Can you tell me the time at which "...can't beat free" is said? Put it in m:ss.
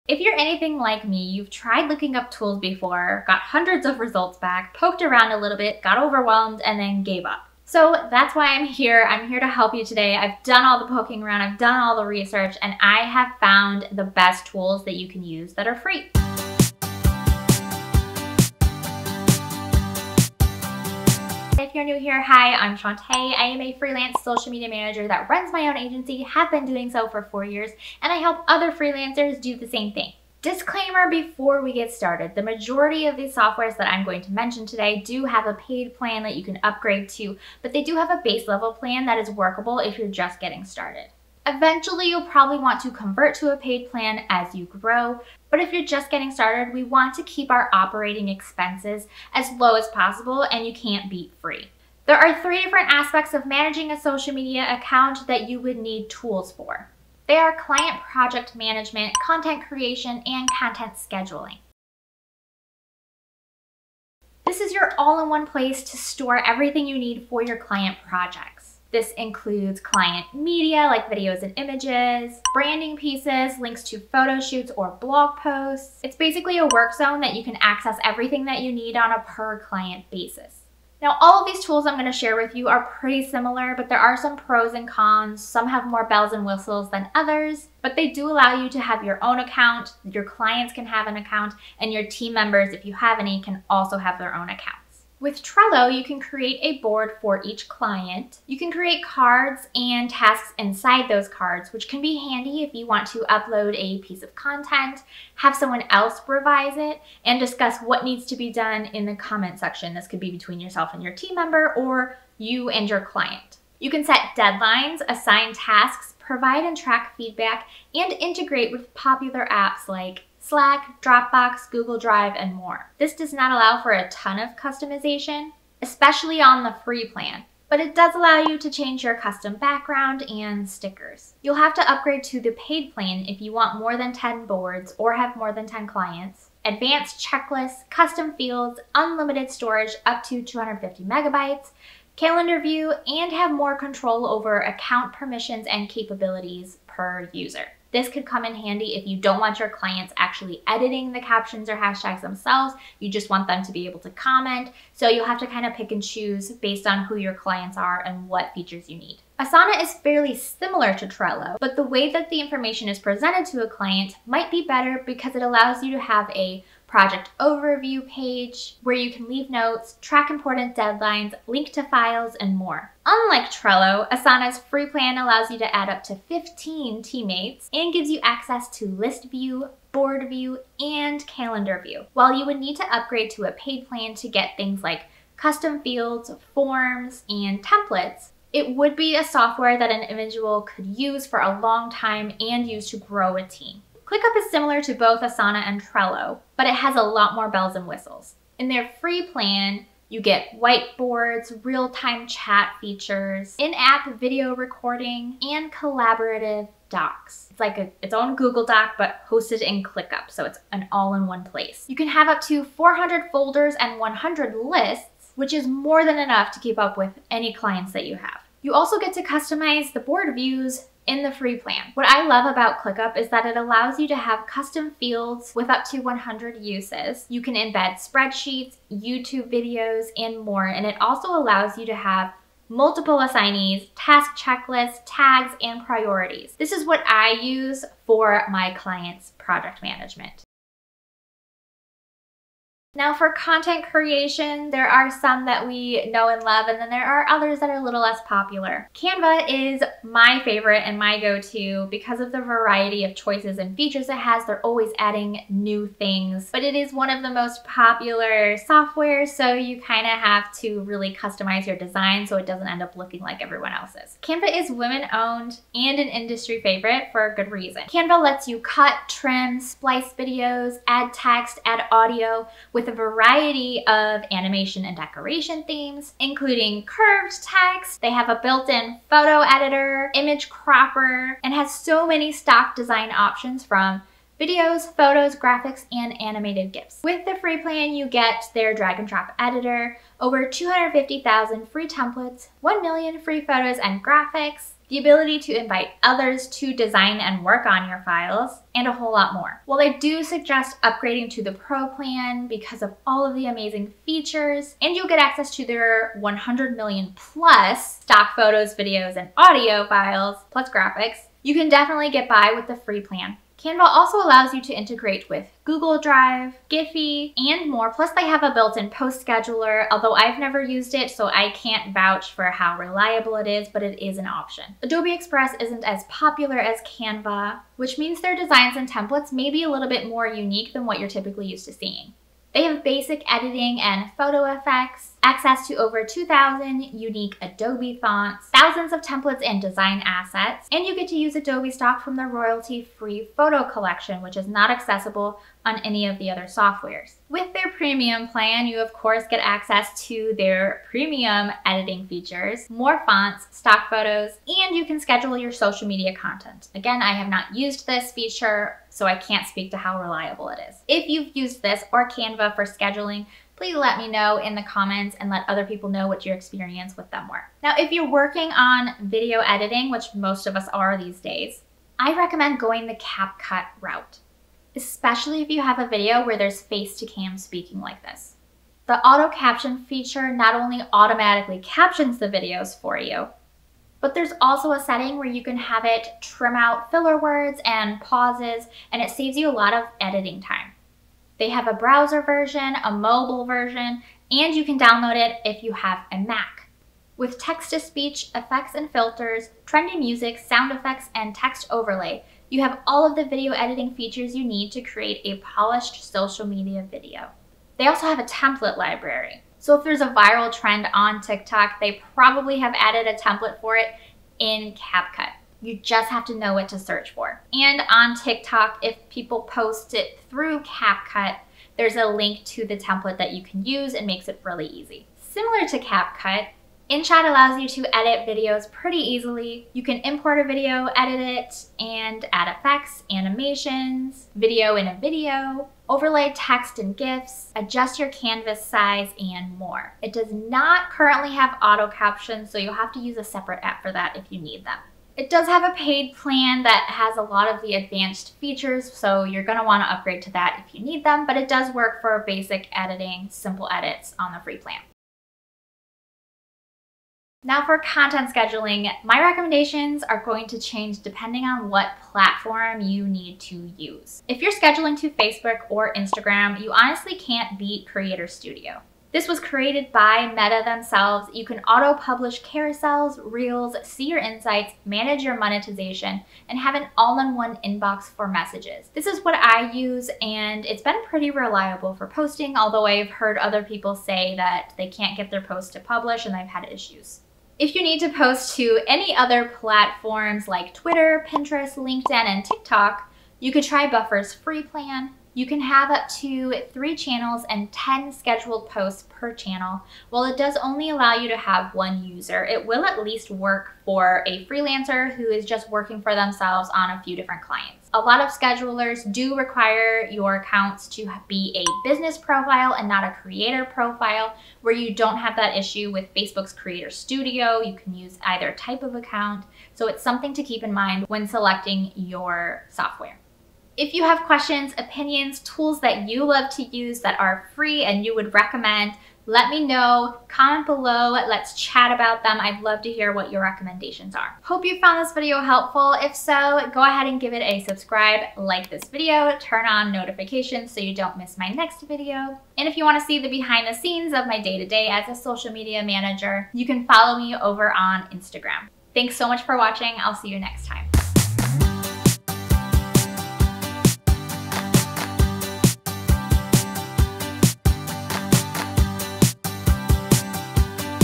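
0:50.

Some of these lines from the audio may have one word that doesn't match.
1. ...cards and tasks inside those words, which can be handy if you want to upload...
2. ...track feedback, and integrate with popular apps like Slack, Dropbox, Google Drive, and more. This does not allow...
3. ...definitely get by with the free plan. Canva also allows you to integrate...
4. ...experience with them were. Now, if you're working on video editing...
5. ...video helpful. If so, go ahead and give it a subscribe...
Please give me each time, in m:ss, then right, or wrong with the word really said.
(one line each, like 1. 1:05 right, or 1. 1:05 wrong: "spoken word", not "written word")
1. 1:39 wrong: "cards", not "words"
2. 1:56 right
3. 5:11 right
4. 6:06 right
5. 8:55 right.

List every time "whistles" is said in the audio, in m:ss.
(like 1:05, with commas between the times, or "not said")
1:26, 3:17.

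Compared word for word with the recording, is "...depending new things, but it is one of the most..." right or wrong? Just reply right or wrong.
wrong.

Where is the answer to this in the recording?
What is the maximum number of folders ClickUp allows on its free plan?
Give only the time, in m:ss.
3:32.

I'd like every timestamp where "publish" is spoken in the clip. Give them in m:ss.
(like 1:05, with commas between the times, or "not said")
7:51, 8:05.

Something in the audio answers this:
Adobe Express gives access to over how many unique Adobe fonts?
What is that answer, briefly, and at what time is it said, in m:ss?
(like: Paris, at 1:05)
2,000, at 5:36.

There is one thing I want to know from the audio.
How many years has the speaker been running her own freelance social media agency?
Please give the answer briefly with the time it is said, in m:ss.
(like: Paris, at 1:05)
4, at 0:27.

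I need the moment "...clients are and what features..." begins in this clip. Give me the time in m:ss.
2:37.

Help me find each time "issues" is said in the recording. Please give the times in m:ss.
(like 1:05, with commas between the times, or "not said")
8:06, 8:35.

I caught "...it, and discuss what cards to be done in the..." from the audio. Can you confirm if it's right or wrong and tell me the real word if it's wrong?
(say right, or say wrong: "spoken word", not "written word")
wrong: "needs", not "cards".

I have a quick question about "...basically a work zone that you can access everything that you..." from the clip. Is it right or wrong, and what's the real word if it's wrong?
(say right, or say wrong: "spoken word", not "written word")
right.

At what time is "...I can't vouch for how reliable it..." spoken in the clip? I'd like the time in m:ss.
5:21.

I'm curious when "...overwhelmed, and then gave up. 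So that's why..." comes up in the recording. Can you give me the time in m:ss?
0:06.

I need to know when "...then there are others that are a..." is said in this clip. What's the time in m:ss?
4:06.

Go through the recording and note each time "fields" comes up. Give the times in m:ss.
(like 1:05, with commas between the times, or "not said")
2:18, 3:05, 3:44.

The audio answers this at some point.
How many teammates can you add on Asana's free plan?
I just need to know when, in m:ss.
2:55.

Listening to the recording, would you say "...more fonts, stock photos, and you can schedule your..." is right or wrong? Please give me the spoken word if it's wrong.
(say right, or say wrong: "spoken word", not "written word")
right.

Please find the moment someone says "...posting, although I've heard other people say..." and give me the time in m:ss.
8:02.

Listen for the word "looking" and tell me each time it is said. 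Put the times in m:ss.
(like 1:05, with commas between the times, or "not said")
0:01, 4:22.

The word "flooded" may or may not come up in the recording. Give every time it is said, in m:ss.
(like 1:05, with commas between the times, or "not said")
not said.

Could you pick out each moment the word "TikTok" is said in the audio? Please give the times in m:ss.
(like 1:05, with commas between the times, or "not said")
6:51, 6:58, 8:12.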